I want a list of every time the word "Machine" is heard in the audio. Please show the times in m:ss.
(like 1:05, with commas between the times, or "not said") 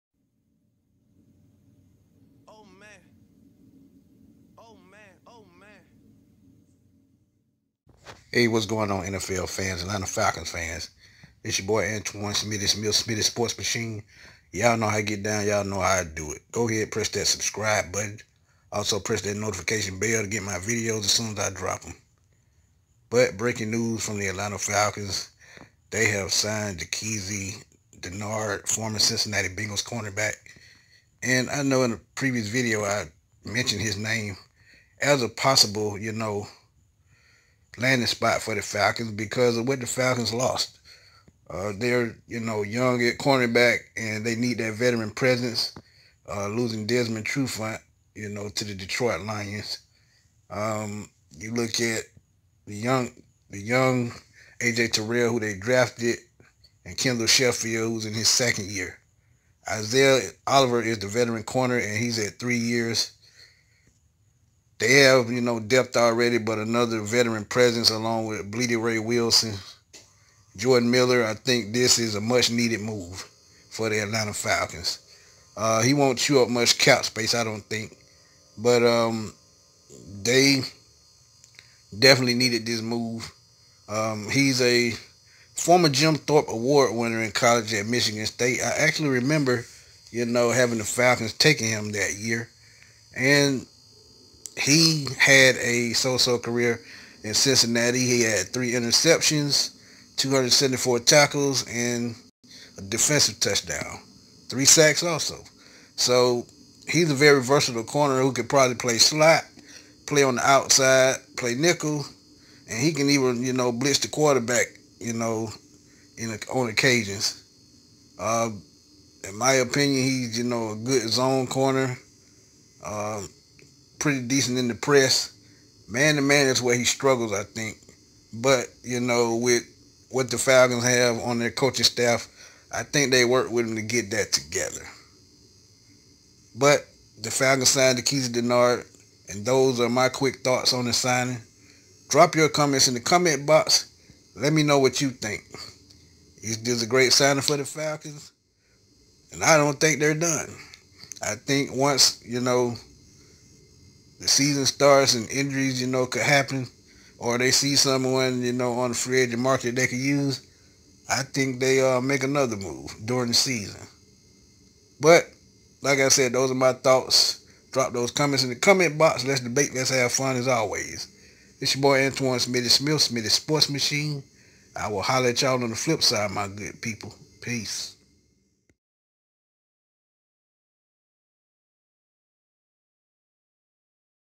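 0:13, 2:53.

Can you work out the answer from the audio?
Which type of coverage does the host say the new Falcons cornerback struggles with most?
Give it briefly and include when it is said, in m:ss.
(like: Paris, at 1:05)
Man to man, at 2:05.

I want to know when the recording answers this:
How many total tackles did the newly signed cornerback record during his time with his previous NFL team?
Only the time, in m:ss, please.
1:40.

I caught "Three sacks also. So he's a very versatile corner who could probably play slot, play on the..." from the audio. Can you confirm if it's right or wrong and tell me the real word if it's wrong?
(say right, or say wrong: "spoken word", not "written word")
right.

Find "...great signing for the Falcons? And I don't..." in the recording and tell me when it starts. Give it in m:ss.
2:26.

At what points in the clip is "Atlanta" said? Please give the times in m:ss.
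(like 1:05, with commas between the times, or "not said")
0:09, 0:24, 1:13.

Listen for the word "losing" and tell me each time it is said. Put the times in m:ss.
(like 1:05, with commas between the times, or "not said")
0:46.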